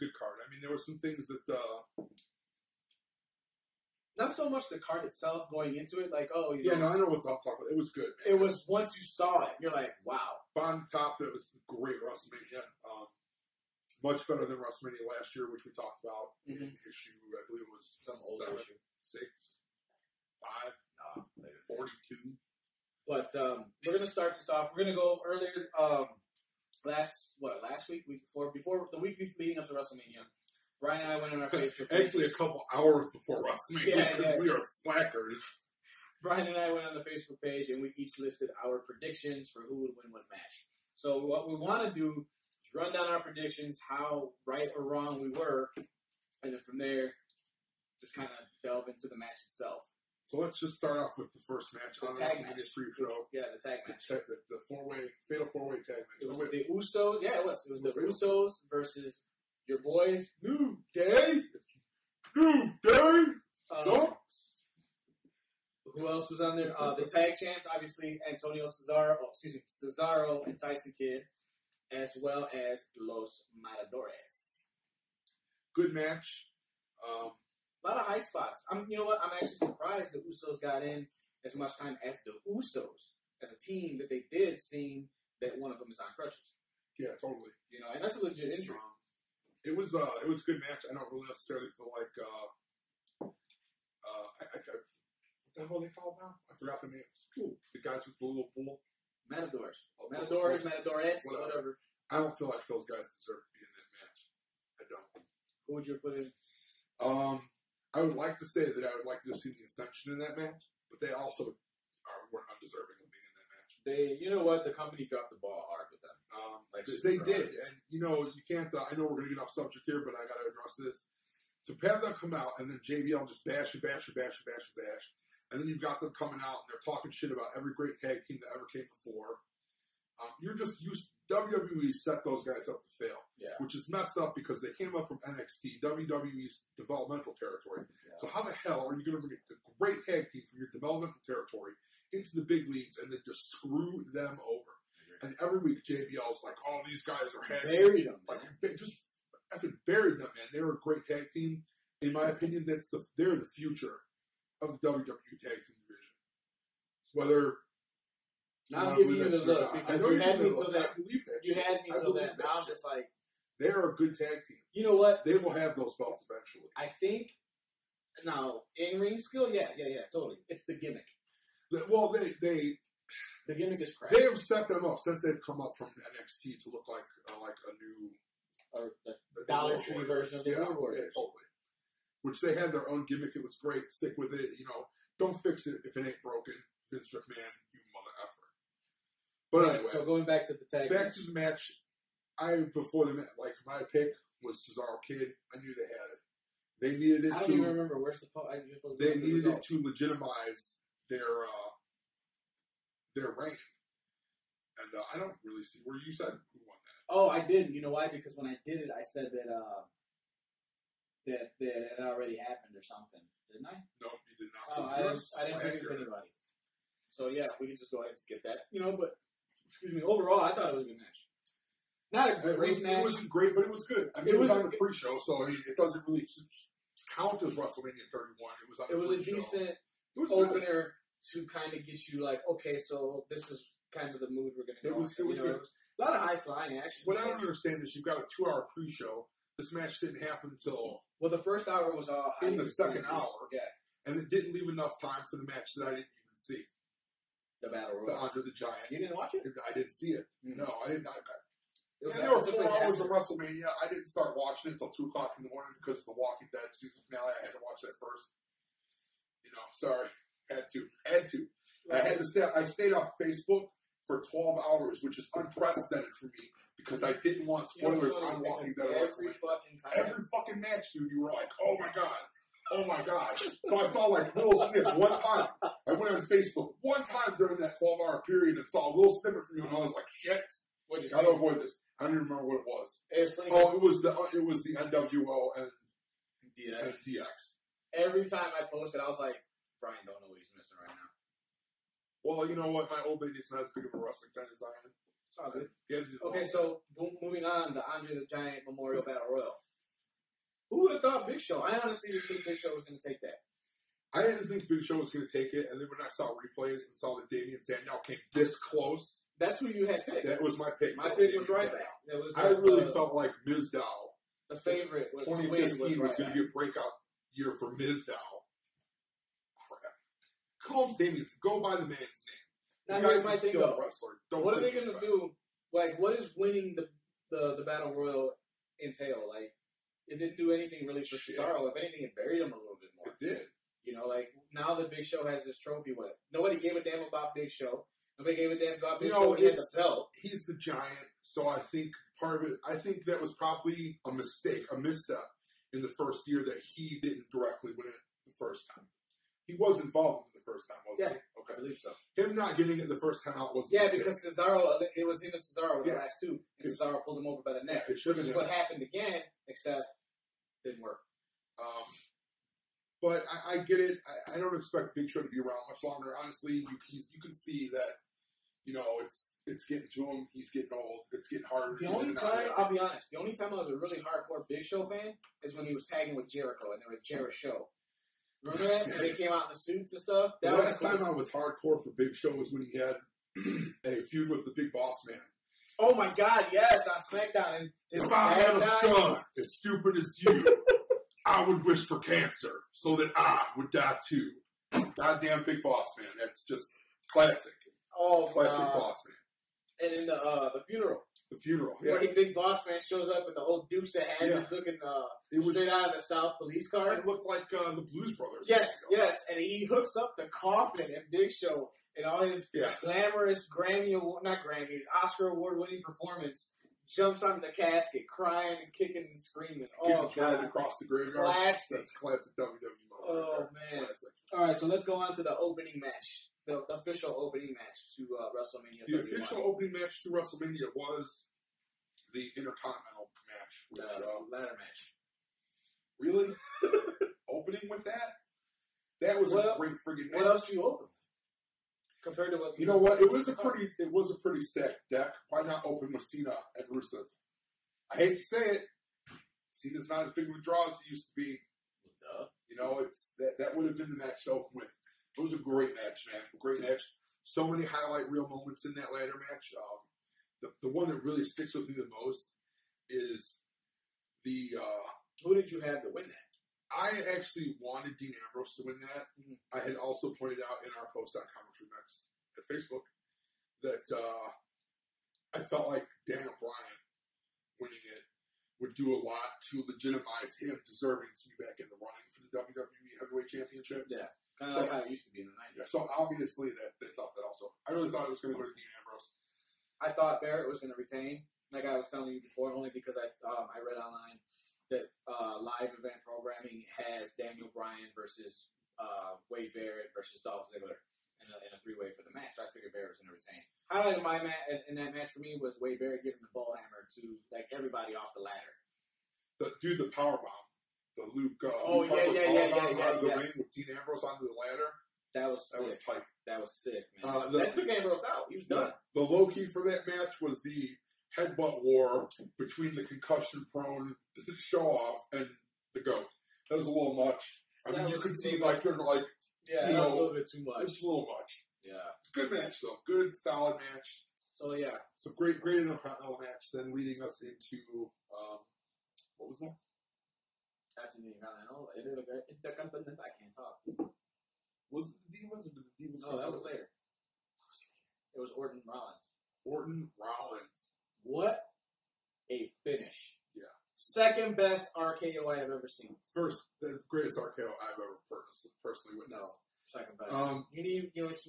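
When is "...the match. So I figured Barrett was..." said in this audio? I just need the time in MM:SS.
08:22.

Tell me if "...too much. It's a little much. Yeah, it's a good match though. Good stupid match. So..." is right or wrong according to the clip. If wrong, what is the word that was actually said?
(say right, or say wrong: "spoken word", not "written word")
wrong: "solid", not "stupid".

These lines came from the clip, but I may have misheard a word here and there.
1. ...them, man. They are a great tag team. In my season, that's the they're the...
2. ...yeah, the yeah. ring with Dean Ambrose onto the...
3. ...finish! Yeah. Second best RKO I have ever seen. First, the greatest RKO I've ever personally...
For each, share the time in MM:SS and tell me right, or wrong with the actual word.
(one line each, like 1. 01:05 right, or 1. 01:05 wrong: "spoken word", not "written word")
1. 02:30 wrong: "opinion", not "season"
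2. 08:32 right
3. 09:12 right.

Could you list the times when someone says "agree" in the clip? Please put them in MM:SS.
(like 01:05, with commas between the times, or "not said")
not said.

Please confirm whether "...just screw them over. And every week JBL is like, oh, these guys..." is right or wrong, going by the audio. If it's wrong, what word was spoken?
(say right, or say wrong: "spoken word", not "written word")
right.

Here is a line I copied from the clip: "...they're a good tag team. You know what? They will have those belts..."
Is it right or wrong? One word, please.
right.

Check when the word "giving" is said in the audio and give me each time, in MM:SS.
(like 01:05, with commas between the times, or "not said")
02:38, 08:26.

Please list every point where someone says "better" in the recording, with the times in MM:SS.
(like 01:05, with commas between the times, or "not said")
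00:14.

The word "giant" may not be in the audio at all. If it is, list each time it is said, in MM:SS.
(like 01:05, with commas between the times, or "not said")
04:08, 04:58, 05:40.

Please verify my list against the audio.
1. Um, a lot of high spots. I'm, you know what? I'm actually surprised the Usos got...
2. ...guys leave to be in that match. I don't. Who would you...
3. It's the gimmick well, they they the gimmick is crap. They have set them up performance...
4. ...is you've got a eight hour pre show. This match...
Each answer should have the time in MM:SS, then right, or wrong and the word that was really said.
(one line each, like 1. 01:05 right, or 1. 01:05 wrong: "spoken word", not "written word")
1. 01:17 right
2. 01:42 wrong: "deserve", not "leave"
3. 02:50 wrong: "since", not "performance"
4. 03:57 wrong: "two", not "eight".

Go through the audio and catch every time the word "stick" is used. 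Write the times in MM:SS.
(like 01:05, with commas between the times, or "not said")
03:03, 07:41.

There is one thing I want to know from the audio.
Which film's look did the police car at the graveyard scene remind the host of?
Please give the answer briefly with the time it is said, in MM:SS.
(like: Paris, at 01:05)
The Blues Brothers, at 06:47.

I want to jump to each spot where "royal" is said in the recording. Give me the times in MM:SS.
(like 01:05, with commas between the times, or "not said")
04:08, 04:59, 05:27.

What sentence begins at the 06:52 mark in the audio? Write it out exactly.
glamorous Grammy not Grammys, Oscar award winning performance.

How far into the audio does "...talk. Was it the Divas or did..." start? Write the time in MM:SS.
09:03.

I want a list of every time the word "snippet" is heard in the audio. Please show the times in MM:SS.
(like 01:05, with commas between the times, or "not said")
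04:34, 04:39.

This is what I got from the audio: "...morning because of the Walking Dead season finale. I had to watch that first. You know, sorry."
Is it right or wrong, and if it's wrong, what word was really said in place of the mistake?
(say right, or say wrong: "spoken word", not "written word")
right.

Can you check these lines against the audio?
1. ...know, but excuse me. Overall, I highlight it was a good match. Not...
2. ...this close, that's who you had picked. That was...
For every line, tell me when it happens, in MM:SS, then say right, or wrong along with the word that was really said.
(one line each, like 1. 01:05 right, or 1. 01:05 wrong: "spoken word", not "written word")
1. 03:38 wrong: "thought", not "highlight"
2. 05:08 right.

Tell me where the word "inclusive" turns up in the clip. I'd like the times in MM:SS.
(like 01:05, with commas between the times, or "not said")
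not said.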